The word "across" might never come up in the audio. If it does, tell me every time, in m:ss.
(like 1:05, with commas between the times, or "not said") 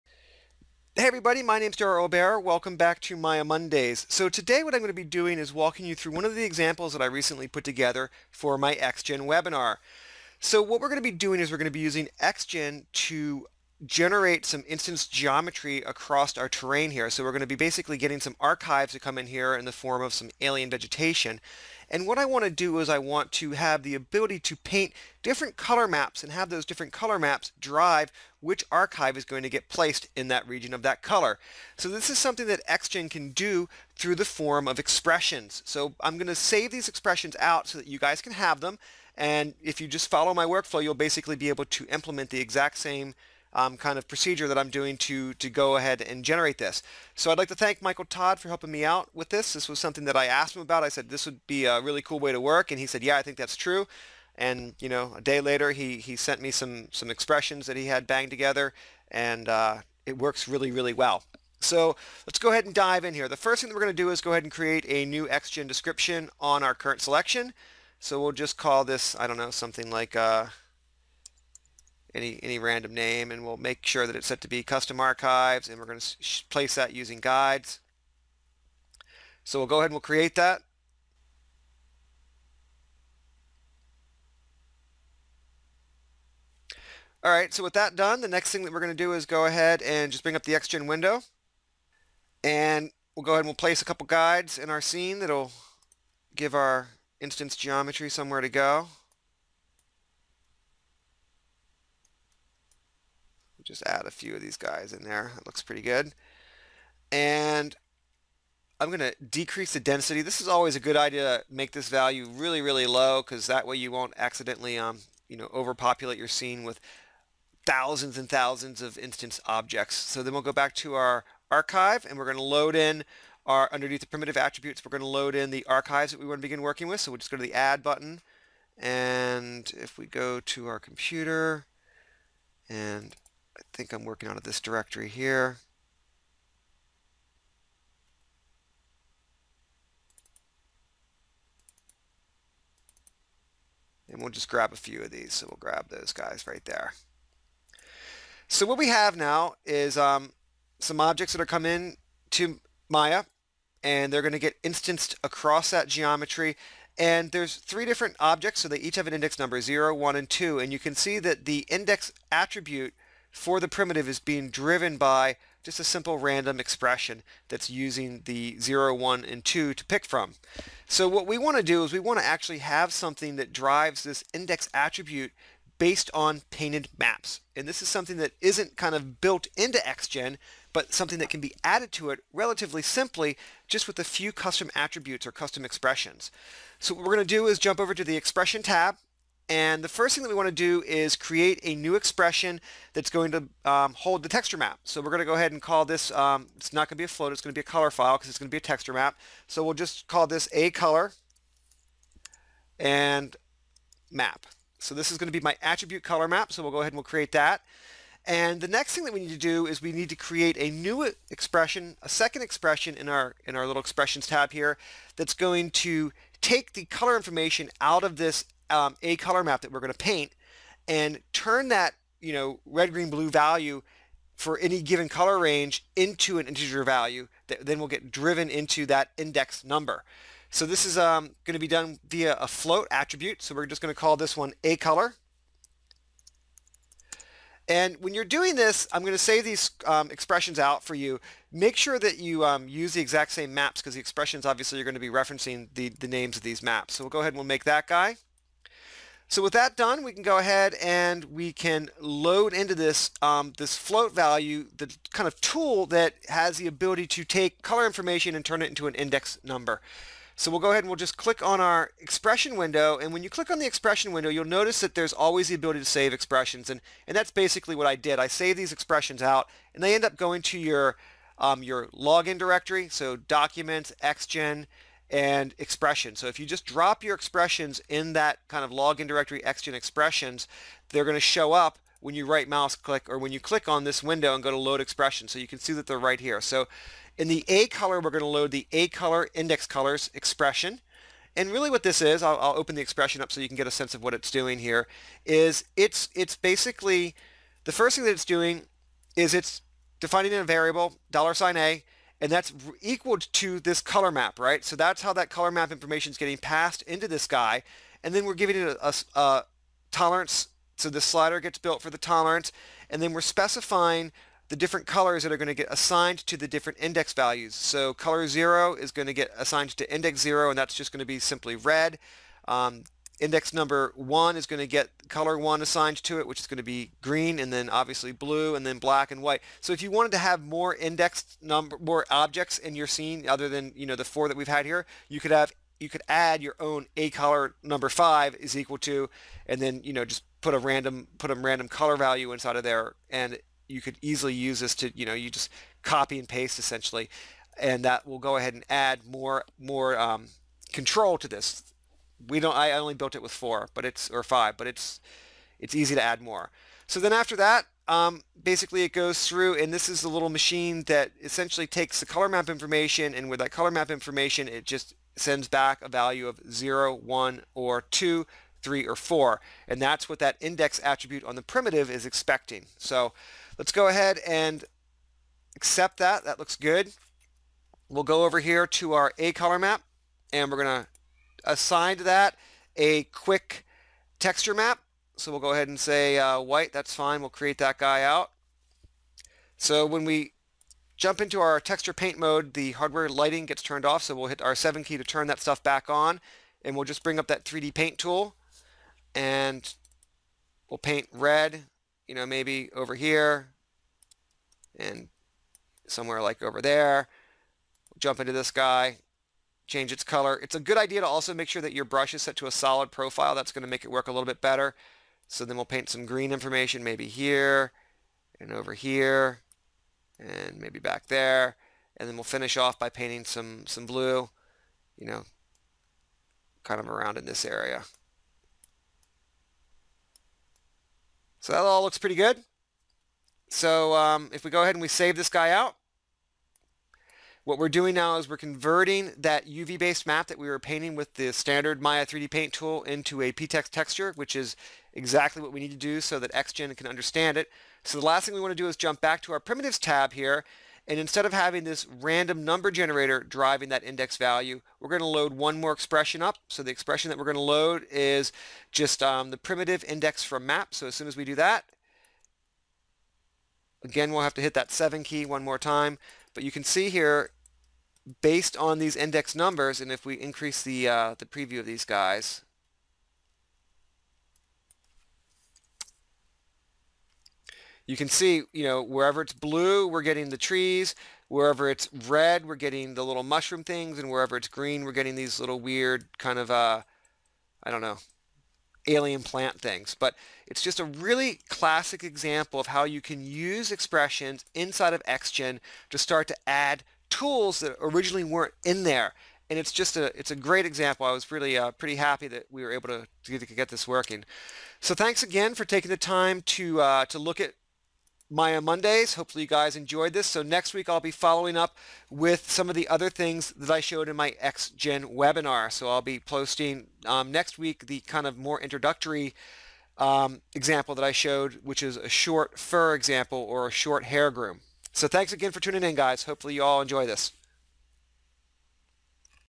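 0:15, 2:35.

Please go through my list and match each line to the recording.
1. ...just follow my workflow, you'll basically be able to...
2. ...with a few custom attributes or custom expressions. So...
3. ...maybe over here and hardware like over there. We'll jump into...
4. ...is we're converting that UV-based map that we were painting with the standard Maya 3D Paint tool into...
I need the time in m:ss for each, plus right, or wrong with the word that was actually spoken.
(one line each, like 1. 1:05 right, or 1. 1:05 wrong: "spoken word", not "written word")
1. 0:39 right
2. 3:03 right
3. 6:42 wrong: "somewhere", not "hardware"
4. 7:18 right.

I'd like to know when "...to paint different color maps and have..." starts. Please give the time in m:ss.
0:24.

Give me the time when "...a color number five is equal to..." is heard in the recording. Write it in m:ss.
5:36.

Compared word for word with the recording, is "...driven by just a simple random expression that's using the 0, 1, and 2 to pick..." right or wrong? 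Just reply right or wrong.
right.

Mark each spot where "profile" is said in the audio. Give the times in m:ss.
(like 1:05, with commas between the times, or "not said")
6:52.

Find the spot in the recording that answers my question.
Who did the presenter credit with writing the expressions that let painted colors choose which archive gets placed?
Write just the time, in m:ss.
0:47.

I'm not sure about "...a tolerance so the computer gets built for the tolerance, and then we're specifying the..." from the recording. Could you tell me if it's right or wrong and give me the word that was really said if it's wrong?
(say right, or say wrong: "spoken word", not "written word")
wrong: "slider", not "computer".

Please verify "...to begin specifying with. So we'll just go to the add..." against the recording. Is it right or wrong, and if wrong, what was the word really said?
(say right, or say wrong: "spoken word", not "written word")
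wrong: "working", not "specifying".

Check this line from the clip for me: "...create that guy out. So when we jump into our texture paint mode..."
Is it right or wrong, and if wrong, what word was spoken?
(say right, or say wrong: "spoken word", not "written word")
right.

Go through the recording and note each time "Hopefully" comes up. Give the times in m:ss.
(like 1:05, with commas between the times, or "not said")
8:29, 8:46.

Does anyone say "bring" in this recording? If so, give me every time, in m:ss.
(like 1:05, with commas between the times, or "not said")
1:30, 6:37.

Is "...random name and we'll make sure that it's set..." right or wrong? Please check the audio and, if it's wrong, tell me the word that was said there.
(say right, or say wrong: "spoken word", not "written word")
right.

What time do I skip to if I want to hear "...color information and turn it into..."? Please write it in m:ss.
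4:17.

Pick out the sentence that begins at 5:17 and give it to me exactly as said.
So color 0 is going to get assigned to index 0, and that's just going to be simply red.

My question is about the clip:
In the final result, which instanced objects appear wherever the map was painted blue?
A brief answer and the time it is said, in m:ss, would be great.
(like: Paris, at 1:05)
trees, at 8:00.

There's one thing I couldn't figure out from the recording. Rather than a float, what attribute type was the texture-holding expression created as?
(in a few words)
color file.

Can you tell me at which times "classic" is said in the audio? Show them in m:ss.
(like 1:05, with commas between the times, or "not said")
8:11.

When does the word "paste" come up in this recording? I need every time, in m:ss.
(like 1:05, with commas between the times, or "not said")
5:46.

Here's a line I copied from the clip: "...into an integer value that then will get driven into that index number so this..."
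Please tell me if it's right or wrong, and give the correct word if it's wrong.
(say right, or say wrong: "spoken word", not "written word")
right.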